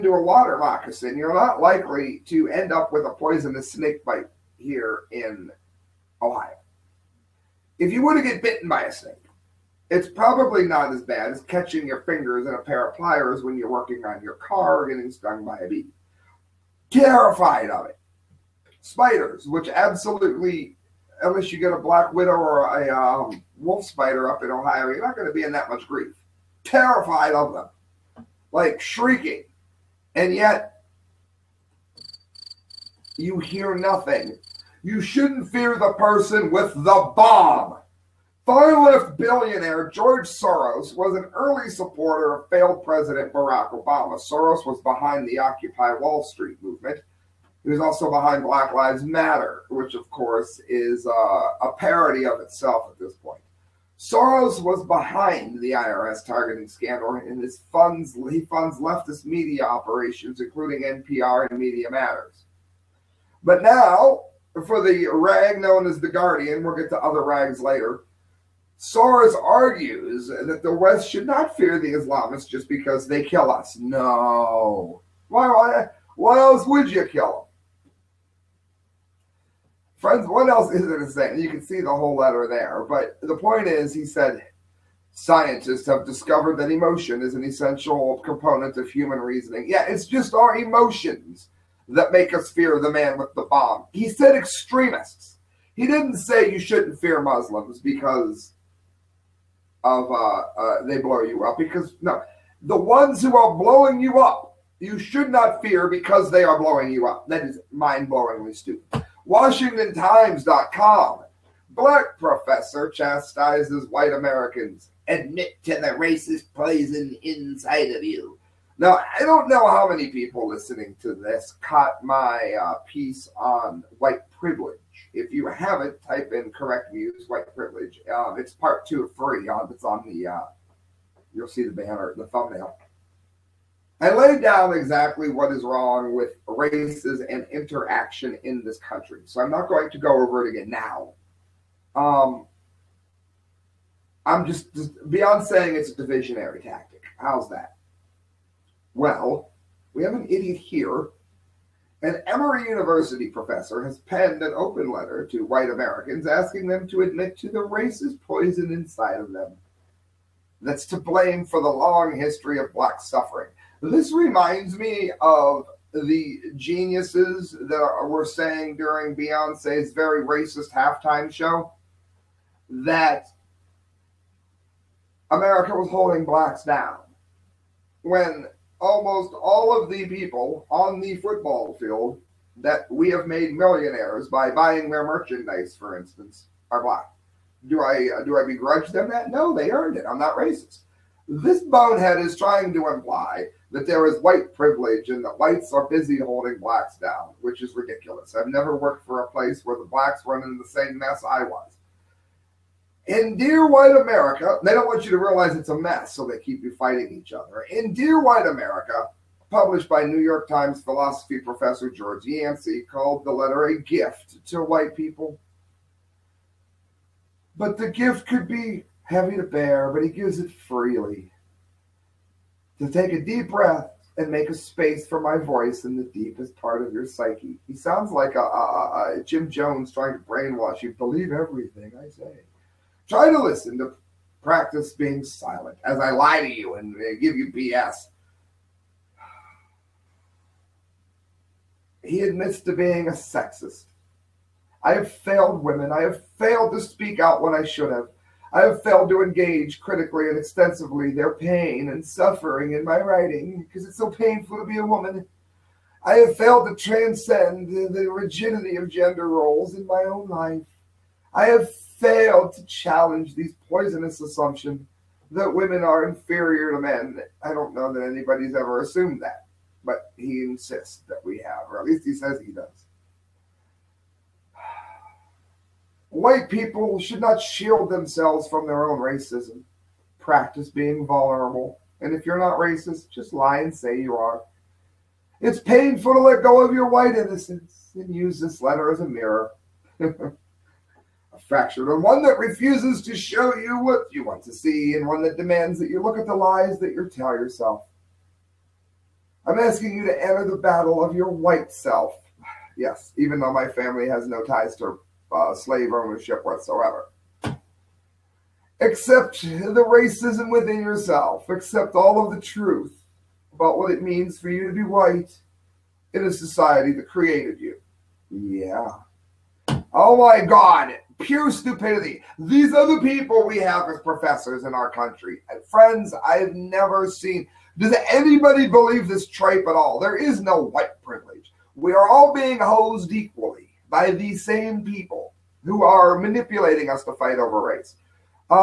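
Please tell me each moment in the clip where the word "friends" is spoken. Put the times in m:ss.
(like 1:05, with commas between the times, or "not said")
1:19, 5:25.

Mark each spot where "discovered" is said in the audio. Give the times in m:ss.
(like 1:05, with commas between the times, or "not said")
1:26.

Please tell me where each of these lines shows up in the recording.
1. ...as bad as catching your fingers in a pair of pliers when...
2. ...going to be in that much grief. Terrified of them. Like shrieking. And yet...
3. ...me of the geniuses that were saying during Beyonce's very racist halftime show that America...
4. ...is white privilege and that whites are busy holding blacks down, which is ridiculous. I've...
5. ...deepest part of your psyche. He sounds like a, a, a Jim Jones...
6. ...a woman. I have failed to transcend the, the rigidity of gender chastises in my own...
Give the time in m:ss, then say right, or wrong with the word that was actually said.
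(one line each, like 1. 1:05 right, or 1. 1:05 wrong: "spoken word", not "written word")
1. 0:10 right
2. 0:25 right
3. 2:44 right
4. 3:14 right
5. 3:46 right
6. 4:14 wrong: "roles", not "chastises".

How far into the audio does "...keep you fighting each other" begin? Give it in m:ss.
3:26.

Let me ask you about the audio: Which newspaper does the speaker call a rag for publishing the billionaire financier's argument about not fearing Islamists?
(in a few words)
The Guardian.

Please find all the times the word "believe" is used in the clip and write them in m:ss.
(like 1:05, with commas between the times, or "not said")
3:50, 5:28.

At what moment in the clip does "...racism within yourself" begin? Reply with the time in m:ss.
5:09.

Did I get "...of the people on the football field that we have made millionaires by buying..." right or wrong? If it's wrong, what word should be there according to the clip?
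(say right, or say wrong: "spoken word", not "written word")
right.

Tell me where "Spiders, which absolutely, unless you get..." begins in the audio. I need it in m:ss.
0:18.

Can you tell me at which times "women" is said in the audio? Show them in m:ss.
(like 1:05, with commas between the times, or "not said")
4:05, 4:25.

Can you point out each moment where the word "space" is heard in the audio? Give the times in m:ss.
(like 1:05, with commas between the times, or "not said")
3:44.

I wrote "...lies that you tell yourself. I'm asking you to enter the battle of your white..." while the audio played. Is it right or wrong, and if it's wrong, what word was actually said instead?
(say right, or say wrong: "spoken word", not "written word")
right.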